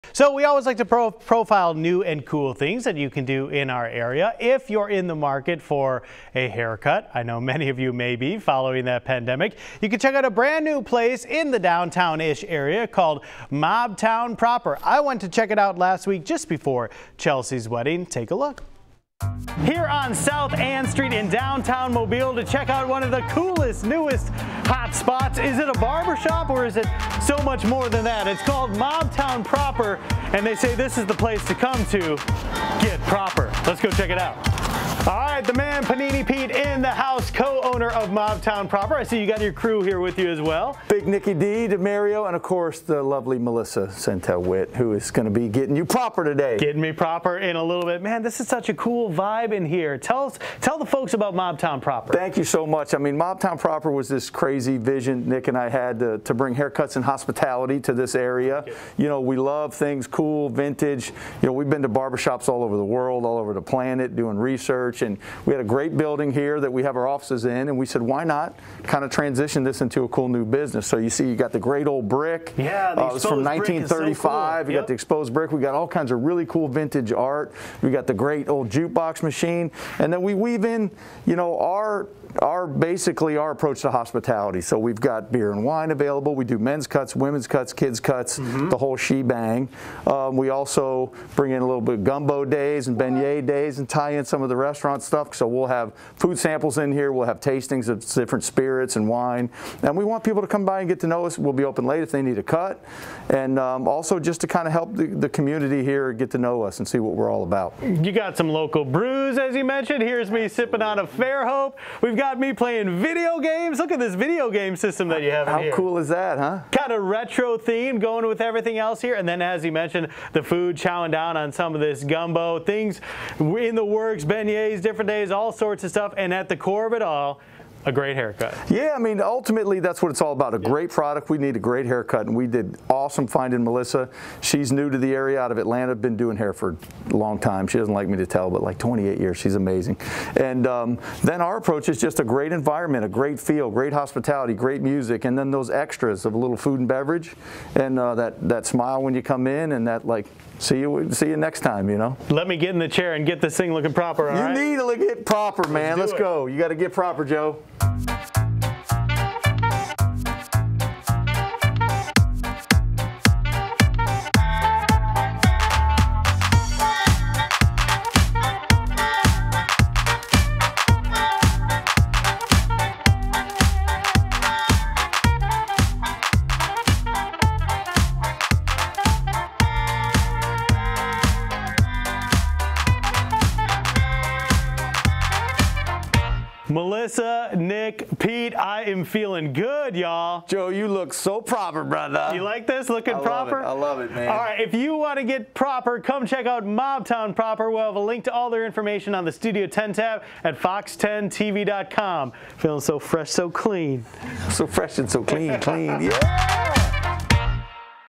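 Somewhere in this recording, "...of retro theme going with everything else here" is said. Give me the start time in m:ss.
1:56.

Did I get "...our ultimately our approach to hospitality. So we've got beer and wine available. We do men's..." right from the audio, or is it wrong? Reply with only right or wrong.
wrong.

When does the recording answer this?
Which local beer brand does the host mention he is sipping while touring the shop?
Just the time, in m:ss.
1:51.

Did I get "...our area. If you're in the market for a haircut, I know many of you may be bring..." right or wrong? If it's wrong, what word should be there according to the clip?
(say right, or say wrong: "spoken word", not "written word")
wrong: "following", not "bring".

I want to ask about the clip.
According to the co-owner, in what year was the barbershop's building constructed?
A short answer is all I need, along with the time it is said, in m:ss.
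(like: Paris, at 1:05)
1935, at 1:13.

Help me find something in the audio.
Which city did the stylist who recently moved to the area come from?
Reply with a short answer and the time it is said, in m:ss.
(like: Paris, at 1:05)
Atlanta, at 2:15.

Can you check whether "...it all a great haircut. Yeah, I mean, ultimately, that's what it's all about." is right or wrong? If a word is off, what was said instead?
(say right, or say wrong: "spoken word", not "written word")
right.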